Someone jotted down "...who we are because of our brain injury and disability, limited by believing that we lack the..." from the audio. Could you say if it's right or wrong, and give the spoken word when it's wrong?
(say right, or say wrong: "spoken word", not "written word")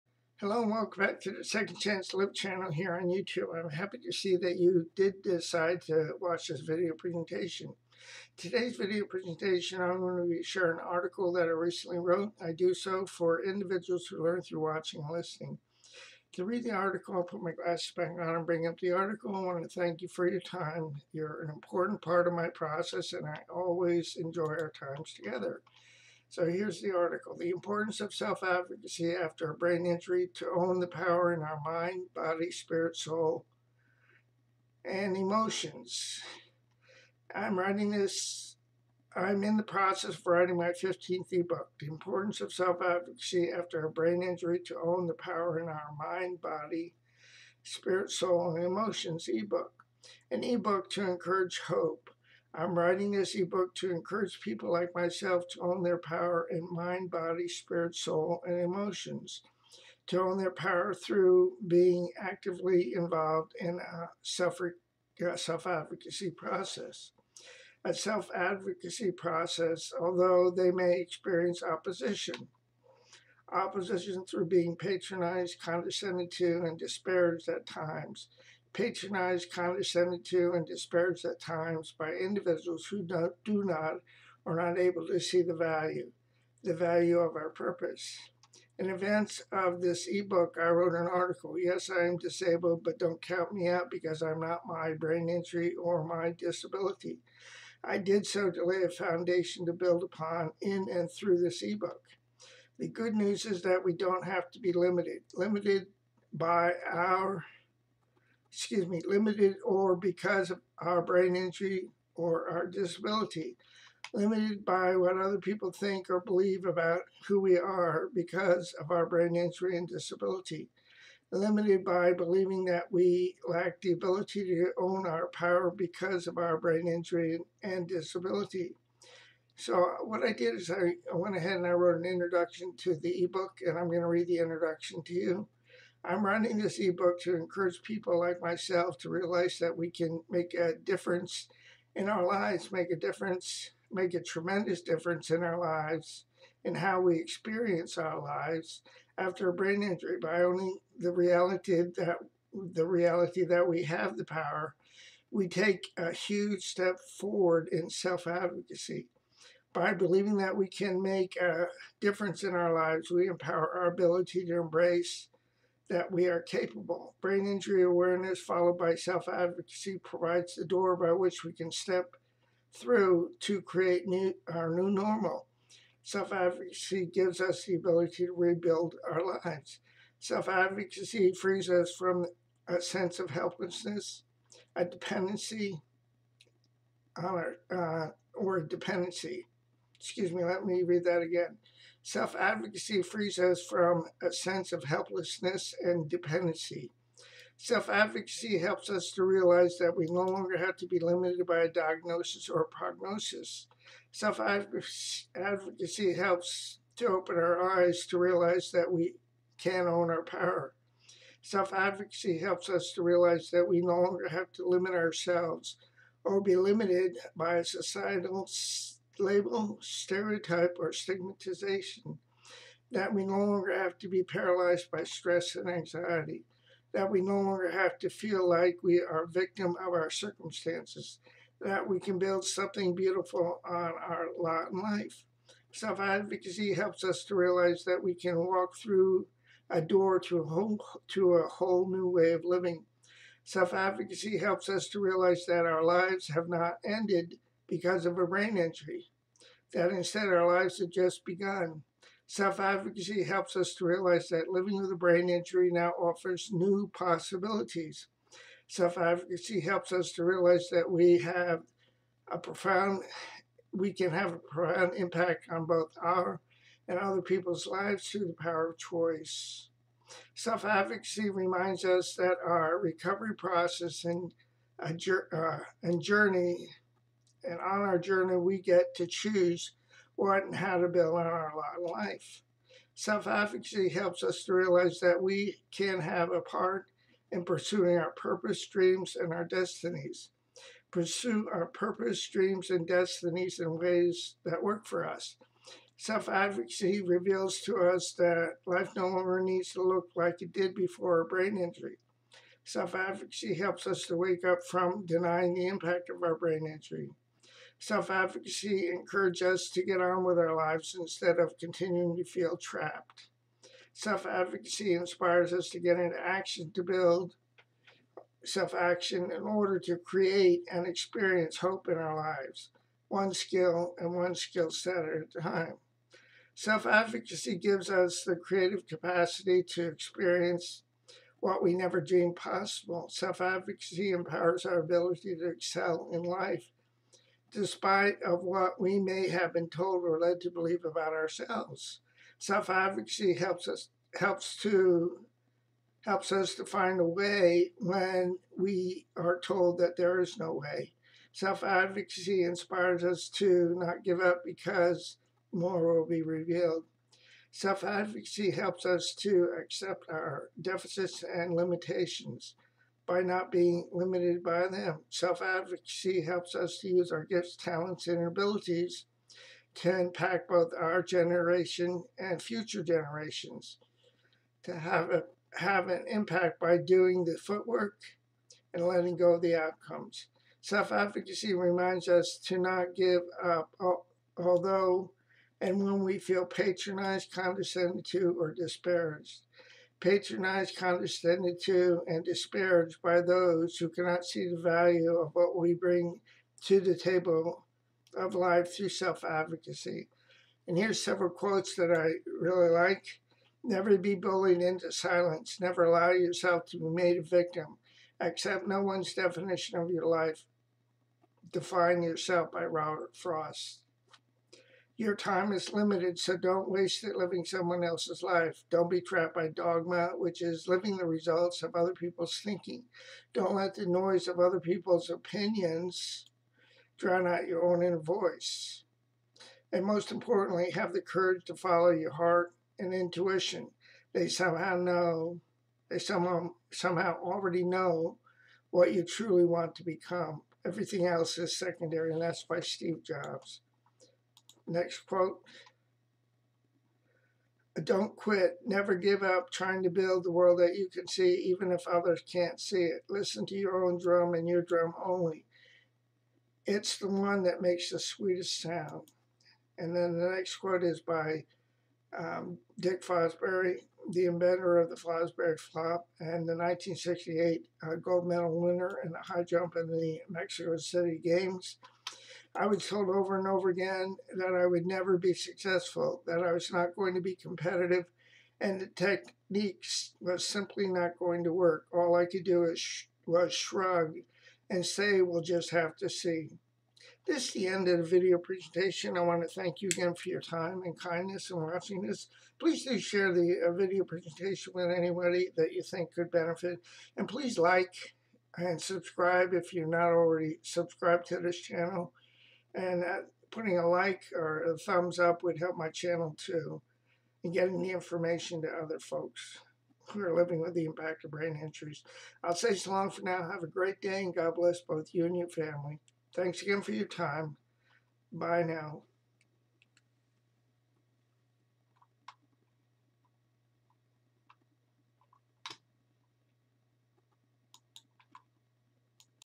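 right.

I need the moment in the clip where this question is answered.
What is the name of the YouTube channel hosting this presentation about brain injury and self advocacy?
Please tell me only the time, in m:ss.
0:01.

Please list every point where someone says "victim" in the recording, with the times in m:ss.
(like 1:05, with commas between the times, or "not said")
3:49, 6:47.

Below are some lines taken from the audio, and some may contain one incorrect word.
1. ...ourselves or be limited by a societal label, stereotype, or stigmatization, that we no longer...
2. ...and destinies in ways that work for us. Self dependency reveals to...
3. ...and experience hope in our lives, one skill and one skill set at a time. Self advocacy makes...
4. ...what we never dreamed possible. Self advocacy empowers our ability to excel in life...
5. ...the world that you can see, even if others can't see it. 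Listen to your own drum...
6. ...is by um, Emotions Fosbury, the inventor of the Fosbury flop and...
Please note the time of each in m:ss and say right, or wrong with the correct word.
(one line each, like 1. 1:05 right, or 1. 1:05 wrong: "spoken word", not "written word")
1. 3:34 right
2. 4:52 wrong: "advocacy", not "dependency"
3. 5:20 wrong: "gives", not "makes"
4. 5:31 right
5. 7:30 right
6. 7:40 wrong: "Dick", not "Emotions".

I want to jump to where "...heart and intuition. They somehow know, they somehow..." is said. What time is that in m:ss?
7:12.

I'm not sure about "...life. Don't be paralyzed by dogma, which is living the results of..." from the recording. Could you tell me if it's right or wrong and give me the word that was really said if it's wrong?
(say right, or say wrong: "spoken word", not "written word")
wrong: "trapped", not "paralyzed".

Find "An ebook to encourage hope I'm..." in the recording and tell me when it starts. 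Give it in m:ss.
0:50.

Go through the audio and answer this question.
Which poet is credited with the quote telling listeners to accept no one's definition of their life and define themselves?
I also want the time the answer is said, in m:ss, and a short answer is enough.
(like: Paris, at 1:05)
Robert Frost, at 6:52.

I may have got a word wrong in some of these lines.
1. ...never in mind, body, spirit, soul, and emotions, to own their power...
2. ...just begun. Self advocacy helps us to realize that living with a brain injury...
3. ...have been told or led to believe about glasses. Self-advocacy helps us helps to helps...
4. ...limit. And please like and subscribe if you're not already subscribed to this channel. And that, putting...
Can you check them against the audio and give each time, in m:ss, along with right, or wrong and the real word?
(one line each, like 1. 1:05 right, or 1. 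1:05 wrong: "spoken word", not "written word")
1. 0:55 wrong: "power", not "never"
2. 4:10 right
3. 5:39 wrong: "ourselves", not "glasses"
4. 8:16 wrong: "benefit", not "limit".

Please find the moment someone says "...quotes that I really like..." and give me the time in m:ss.
6:41.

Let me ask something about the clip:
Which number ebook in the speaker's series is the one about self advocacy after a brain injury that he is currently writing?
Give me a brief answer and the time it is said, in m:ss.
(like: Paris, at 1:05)
15th, at 0:40.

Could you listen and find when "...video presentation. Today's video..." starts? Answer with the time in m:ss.
0:06.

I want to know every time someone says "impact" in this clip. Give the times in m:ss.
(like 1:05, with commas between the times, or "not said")
4:24, 5:05, 6:09, 6:16, 8:30.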